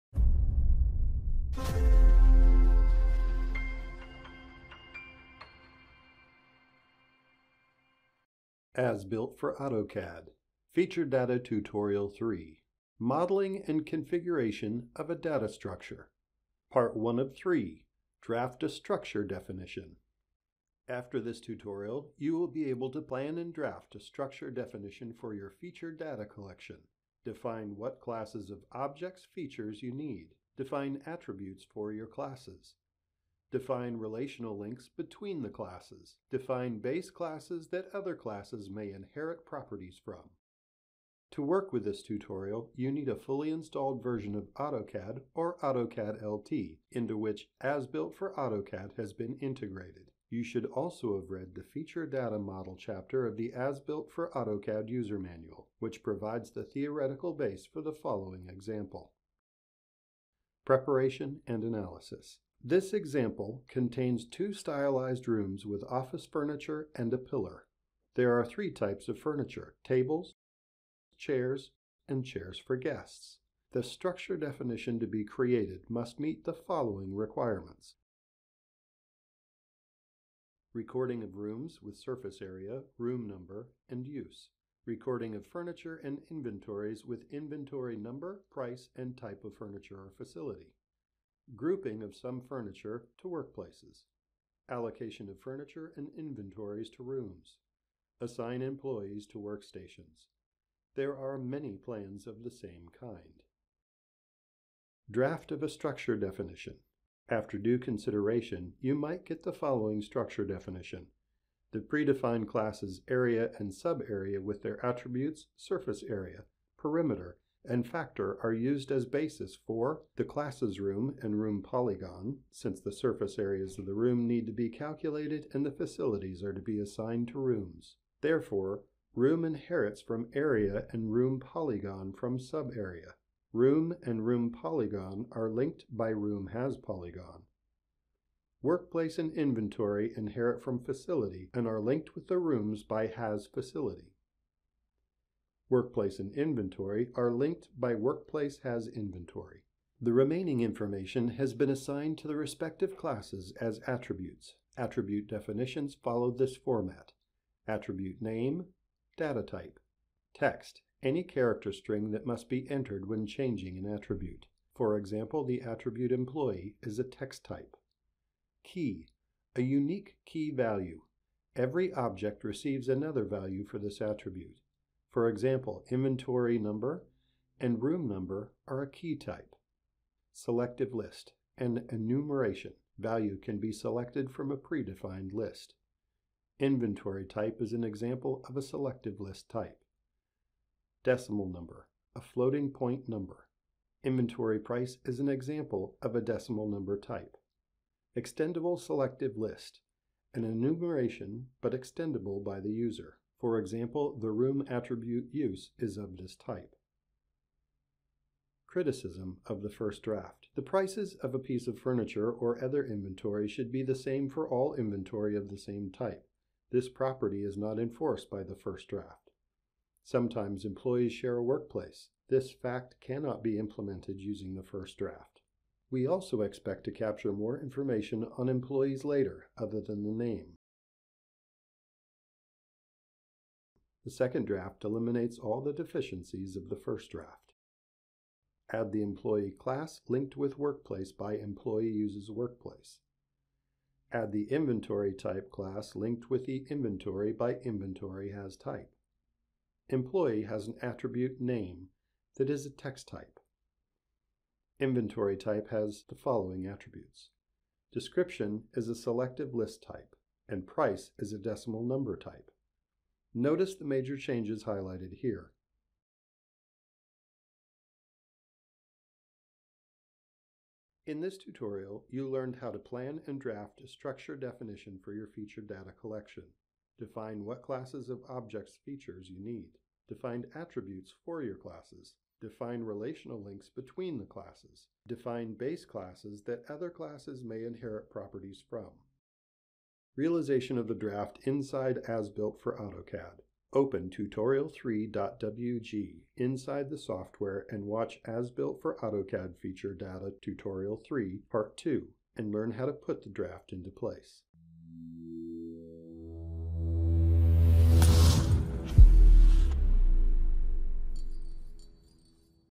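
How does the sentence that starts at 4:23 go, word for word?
Notice the major changes highlighted here.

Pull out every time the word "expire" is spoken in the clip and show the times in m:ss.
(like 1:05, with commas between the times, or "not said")
not said.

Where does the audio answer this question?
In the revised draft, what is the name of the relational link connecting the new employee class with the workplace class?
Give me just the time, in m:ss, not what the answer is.
4:01.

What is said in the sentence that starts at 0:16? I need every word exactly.
Part 1 of 3, Draft a Structure Definition.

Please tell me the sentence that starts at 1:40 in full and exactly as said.
There are many plans of the same kind.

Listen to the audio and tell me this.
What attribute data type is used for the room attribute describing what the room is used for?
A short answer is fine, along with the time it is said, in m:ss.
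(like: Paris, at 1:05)
extendable selective list, at 3:18.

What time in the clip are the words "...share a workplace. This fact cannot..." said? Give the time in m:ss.
3:41.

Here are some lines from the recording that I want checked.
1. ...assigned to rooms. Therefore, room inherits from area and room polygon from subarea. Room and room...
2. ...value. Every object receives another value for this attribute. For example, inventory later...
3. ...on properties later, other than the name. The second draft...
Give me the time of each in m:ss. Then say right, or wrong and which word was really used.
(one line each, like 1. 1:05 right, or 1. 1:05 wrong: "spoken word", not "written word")
1. 2:06 right
2. 2:50 wrong: "number", not "later"
3. 3:48 wrong: "employees", not "properties".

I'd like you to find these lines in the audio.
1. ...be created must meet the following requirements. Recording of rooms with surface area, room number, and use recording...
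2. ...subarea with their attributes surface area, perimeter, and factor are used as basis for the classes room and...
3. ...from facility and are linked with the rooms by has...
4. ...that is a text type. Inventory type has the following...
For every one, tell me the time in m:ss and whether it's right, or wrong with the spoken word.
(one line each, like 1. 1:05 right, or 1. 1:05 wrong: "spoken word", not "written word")
1. 1:15 right
2. 1:53 right
3. 2:20 right
4. 4:12 right.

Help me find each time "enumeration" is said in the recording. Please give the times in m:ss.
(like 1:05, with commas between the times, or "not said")
3:01, 3:20.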